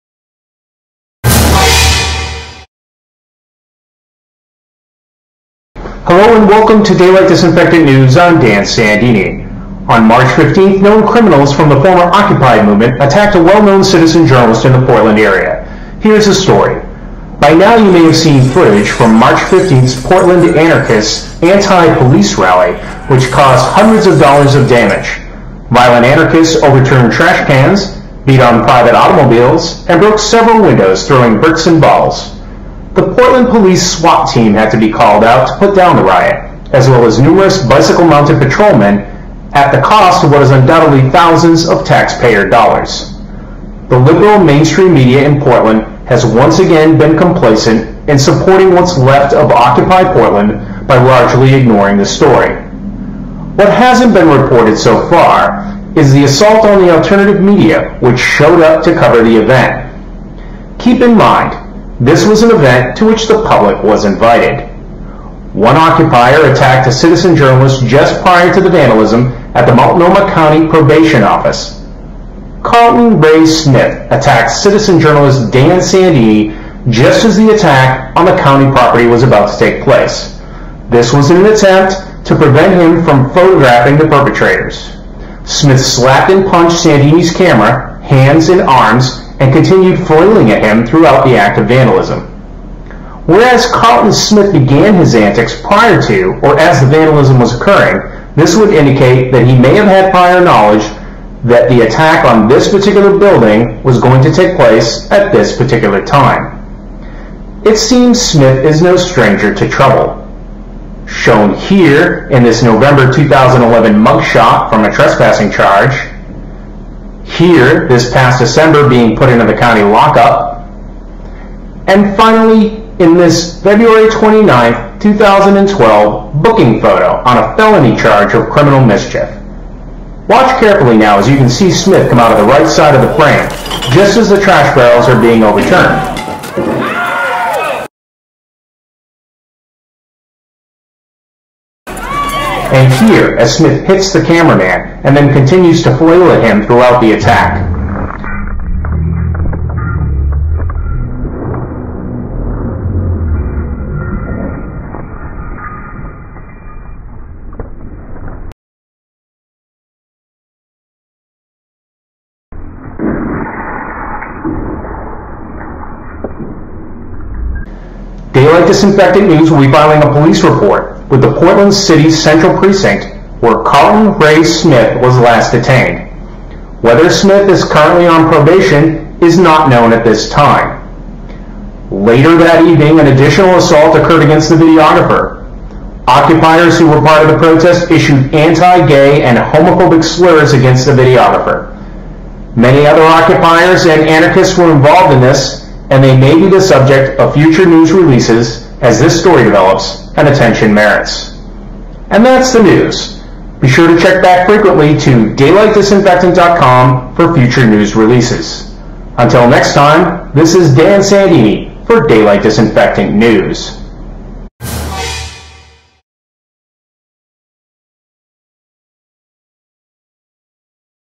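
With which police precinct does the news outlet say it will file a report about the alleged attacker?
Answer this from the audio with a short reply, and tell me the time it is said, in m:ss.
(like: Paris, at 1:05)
Central Precinct, at 2:52.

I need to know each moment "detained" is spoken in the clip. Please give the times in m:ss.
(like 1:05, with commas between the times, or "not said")
2:55.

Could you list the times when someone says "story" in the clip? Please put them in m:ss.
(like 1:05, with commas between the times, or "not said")
0:16, 0:52, 3:19.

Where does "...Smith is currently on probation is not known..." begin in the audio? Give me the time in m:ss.
2:57.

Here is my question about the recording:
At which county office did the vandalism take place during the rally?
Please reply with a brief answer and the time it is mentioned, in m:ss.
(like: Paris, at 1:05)
Multnomah County Probation Office, at 1:09.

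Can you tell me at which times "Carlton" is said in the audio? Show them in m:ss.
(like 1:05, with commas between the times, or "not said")
1:12, 1:33, 2:53.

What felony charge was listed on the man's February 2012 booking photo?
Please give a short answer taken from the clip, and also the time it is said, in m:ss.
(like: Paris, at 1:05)
criminal mischief, at 2:08.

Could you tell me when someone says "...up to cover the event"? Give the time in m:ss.
0:58.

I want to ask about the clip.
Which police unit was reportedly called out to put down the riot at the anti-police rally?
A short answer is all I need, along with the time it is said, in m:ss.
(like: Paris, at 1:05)
SWAT team, at 0:33.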